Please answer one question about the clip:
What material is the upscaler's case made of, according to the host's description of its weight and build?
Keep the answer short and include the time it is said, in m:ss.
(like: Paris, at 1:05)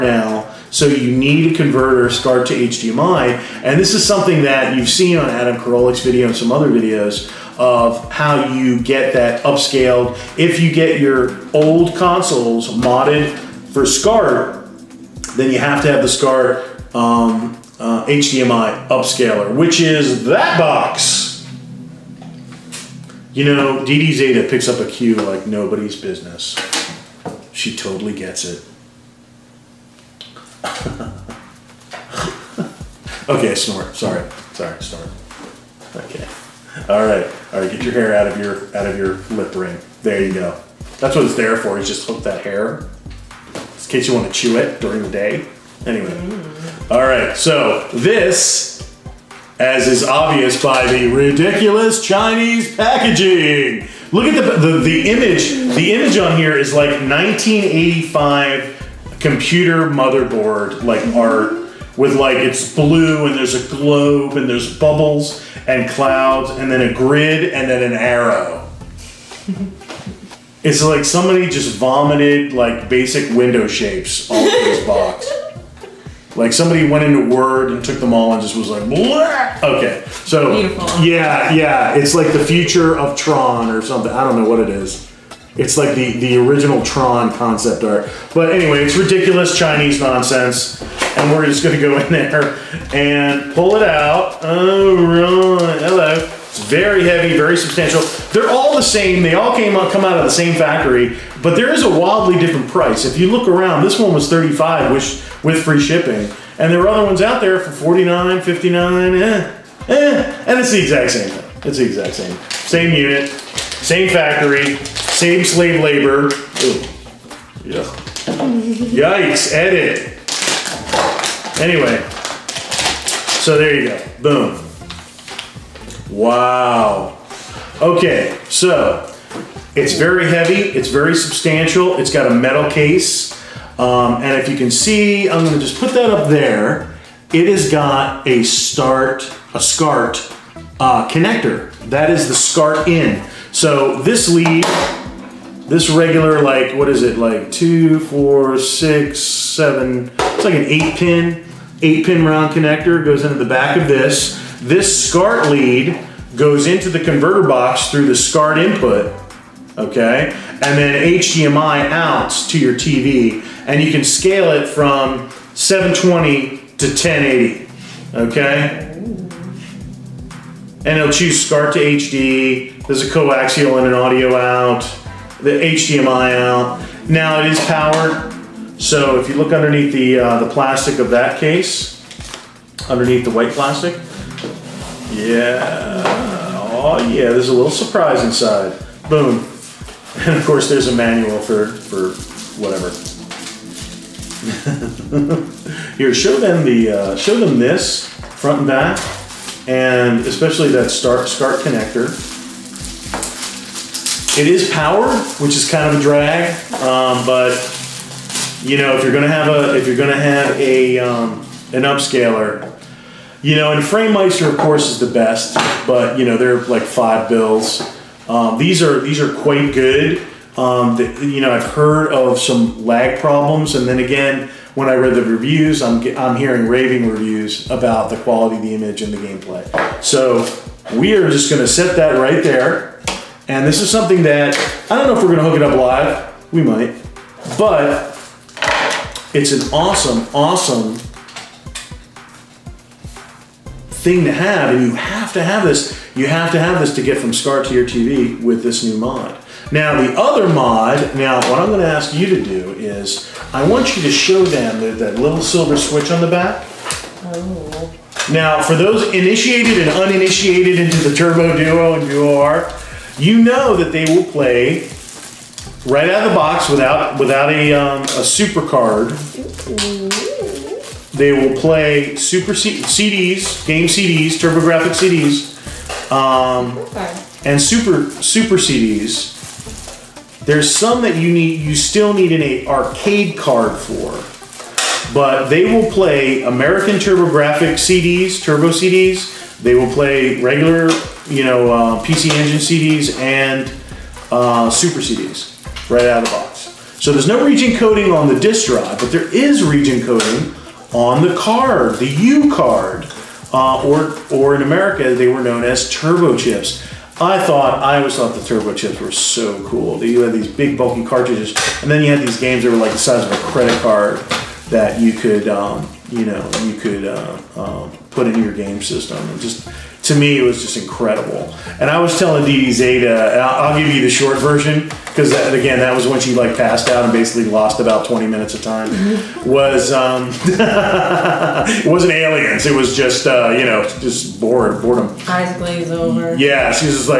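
Metal, at 2:12.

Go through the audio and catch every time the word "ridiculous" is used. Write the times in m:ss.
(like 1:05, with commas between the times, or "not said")
0:51, 1:28.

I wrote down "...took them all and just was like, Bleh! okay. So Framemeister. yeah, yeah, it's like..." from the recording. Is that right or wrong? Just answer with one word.
wrong.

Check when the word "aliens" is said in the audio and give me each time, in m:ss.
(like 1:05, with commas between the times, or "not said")
5:32.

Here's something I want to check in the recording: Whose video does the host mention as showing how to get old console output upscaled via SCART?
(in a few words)
Adam Koralik.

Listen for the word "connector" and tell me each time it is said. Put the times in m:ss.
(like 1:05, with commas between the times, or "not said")
2:21, 2:32, 3:21.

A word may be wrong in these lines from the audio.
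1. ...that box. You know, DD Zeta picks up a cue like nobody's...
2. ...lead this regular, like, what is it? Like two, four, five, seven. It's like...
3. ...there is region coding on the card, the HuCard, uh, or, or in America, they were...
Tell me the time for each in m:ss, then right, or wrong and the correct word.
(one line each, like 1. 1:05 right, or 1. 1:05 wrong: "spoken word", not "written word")
1. 0:20 right
2. 2:24 wrong: "six", not "five"
3. 4:59 right.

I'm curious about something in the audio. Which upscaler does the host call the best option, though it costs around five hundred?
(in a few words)
Framemeister.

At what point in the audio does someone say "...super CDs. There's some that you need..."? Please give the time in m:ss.
4:38.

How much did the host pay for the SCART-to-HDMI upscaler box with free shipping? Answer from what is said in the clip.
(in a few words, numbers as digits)
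35.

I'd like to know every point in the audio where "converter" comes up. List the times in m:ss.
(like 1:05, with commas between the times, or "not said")
0:01, 2:37.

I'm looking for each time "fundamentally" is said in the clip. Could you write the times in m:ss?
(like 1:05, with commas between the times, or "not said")
not said.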